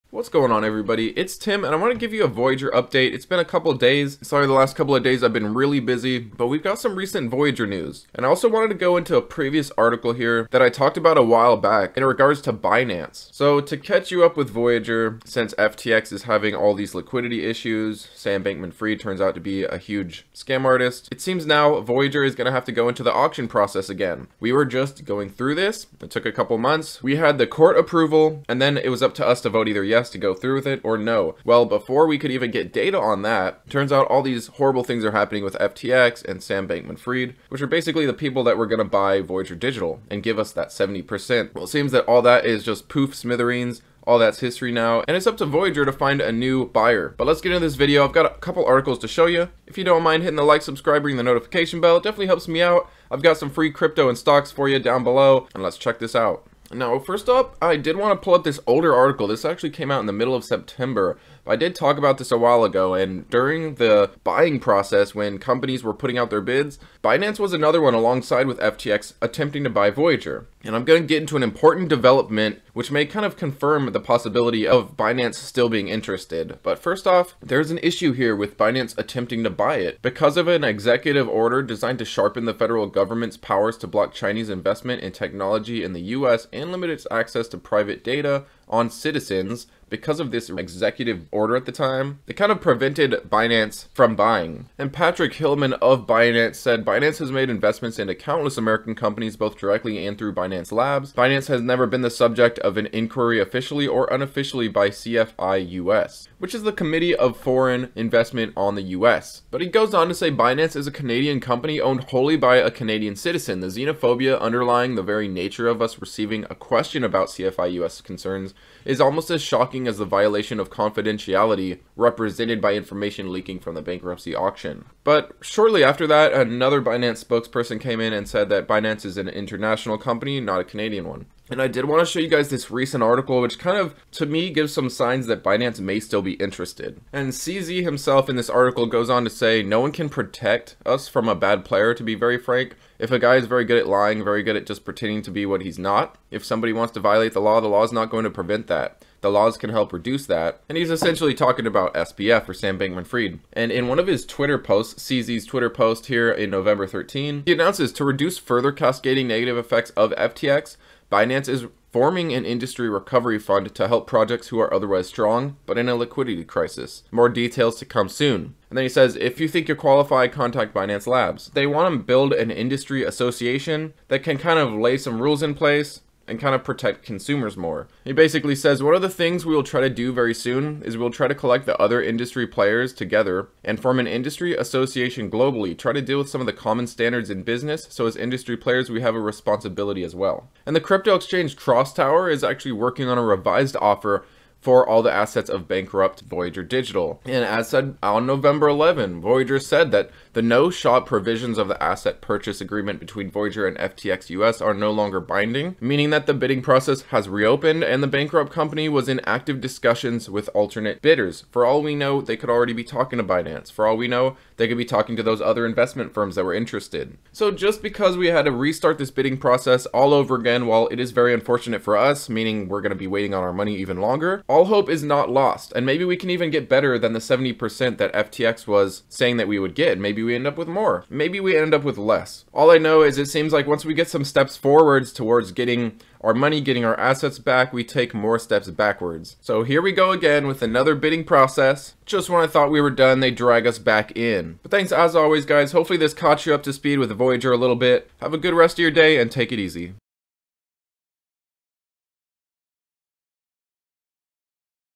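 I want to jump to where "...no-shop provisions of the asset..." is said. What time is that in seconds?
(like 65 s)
200 s.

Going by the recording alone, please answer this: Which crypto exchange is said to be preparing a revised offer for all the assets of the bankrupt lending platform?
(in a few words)
CrossTower.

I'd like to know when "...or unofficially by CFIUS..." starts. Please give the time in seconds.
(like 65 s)
103 s.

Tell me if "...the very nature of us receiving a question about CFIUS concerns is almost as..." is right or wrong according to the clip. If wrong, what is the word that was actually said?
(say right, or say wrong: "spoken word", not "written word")
right.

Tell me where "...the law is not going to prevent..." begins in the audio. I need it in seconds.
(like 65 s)
147 s.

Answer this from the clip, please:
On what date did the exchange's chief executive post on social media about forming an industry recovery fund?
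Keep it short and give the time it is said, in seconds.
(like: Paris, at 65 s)
November 13, at 156 s.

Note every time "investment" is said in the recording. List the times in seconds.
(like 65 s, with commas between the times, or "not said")
84 s, 97 s, 107 s, 215 s.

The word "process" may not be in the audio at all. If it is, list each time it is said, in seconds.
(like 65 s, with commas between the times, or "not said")
23 s, 64 s, 206 s, 219 s, 241 s.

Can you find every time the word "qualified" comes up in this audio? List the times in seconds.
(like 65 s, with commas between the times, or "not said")
169 s.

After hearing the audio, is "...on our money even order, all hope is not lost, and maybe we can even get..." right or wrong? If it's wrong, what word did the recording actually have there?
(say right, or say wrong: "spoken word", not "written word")
wrong: "longer", not "order".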